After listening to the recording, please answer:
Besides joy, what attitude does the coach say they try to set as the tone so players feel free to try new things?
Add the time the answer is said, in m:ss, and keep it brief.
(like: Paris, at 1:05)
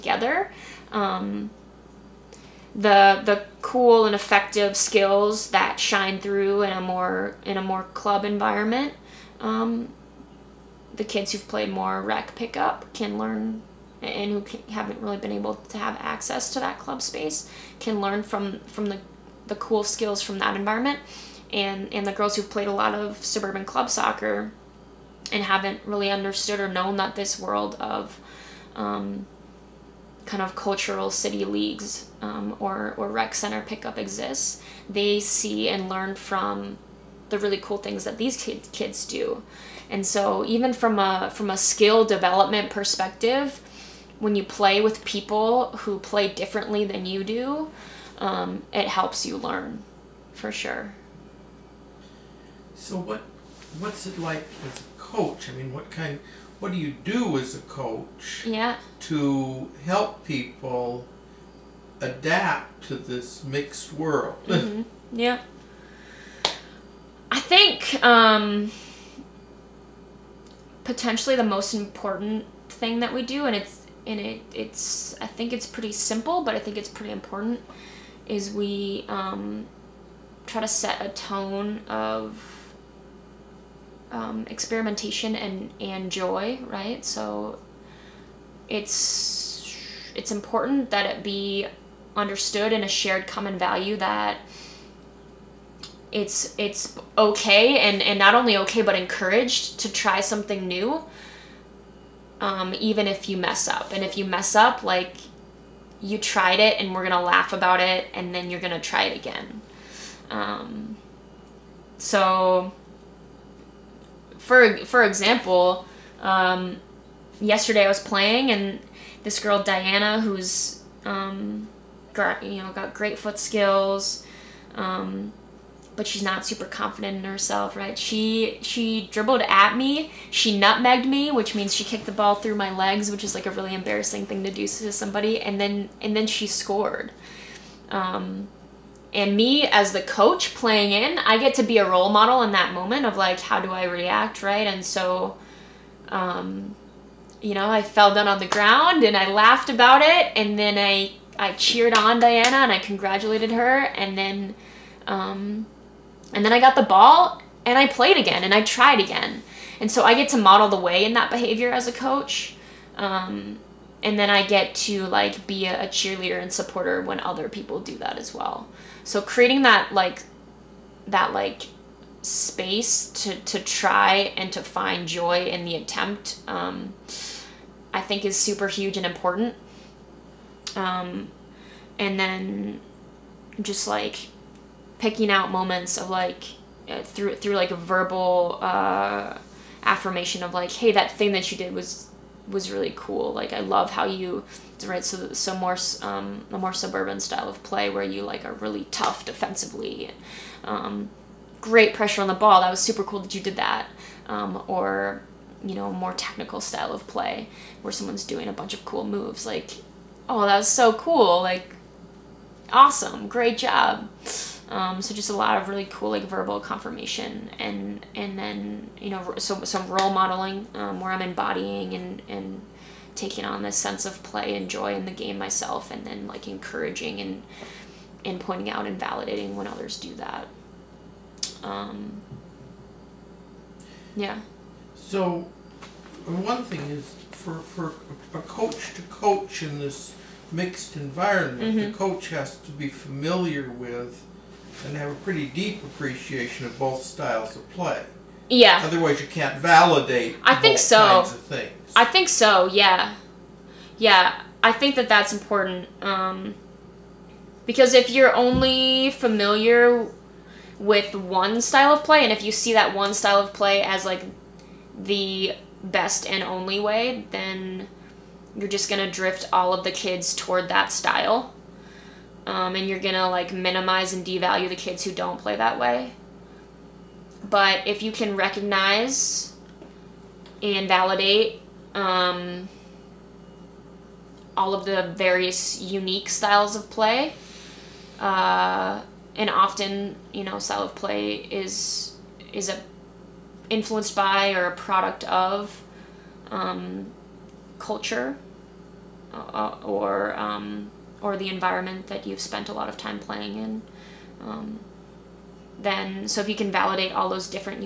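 experimentation, at 1:24.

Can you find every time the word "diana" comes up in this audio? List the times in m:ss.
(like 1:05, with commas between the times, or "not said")
1:59, 2:32.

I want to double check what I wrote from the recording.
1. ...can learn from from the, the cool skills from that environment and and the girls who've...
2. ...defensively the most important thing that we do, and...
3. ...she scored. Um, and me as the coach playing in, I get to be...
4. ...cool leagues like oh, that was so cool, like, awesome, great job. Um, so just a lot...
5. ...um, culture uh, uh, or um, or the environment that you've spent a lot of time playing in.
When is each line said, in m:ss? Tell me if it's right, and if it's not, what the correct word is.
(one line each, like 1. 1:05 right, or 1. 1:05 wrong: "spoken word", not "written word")
1. 0:17 right
2. 1:10 wrong: "potentially", not "defensively"
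3. 2:16 right
4. 3:28 wrong: "moves", not "leagues"
5. 4:56 right.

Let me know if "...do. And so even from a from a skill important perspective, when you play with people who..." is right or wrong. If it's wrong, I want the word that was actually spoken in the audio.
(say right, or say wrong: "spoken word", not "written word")
wrong: "development", not "important".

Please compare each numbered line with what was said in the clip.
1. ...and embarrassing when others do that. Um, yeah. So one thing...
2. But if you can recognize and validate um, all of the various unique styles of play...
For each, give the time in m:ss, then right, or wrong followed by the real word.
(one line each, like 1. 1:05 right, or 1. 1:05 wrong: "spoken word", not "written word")
1. 3:48 wrong: "validating", not "embarrassing"
2. 4:37 right.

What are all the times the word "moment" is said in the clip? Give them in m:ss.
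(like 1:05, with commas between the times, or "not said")
2:22, 3:05.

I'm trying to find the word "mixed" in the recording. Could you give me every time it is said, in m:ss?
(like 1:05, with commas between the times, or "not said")
1:03, 4:00.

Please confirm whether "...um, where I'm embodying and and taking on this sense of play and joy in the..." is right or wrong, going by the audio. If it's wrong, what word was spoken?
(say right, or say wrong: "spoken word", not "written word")
right.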